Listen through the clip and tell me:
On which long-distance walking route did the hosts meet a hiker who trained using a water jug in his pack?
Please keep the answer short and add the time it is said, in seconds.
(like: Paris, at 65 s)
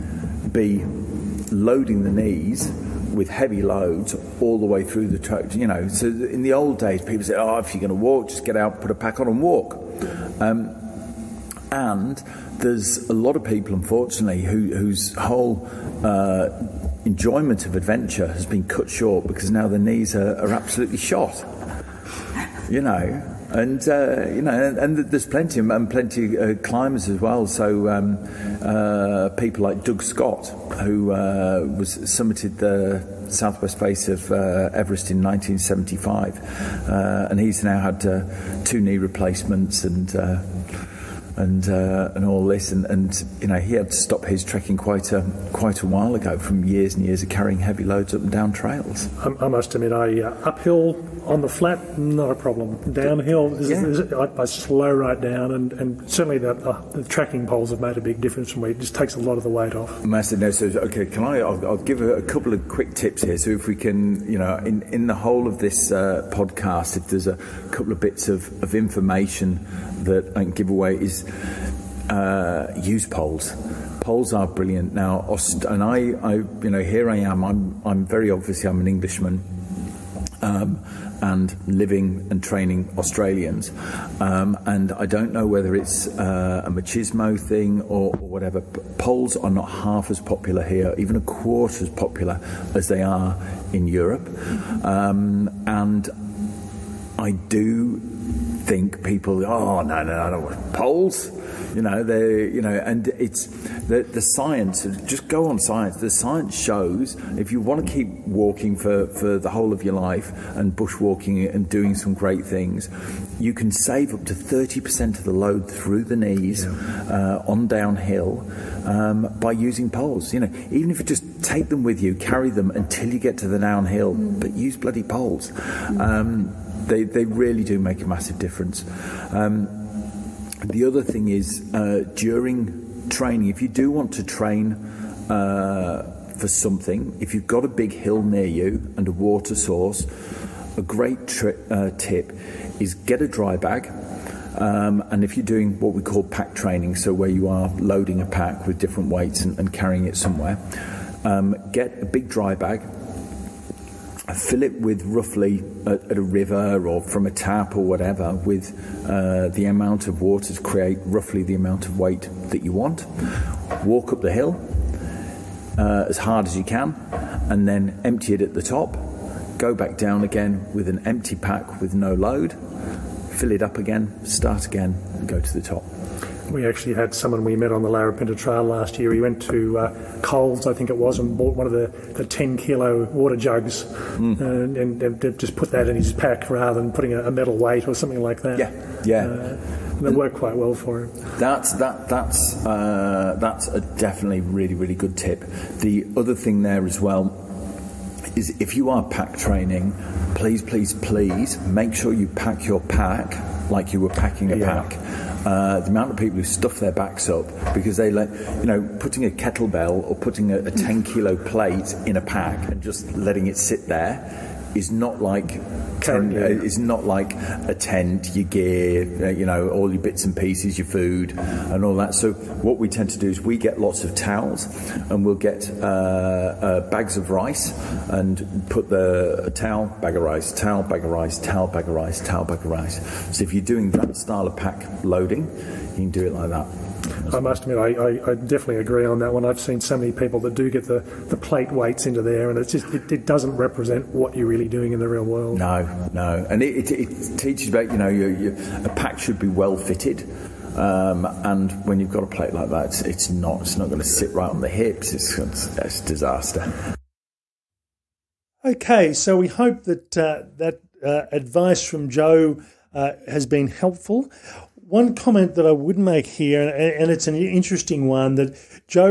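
Larapinta Trail, at 177 s.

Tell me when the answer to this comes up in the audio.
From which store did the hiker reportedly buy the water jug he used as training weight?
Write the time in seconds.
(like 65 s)
180 s.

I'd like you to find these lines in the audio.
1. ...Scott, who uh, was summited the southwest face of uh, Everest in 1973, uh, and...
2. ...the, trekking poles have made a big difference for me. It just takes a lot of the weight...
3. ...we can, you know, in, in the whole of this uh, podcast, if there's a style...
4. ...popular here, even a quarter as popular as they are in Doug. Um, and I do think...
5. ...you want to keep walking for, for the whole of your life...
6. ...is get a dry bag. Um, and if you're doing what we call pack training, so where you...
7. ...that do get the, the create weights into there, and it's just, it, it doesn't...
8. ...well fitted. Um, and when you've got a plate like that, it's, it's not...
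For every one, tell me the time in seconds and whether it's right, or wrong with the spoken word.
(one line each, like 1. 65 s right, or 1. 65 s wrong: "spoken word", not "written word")
1. 30 s wrong: "1975", not "1973"
2. 56 s right
3. 63 s wrong: "couple", not "style"
4. 90 s wrong: "Europe", not "Doug"
5. 107 s right
6. 142 s right
7. 240 s wrong: "plate", not "create"
8. 249 s right.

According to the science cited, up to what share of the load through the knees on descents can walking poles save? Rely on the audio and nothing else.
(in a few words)
30%.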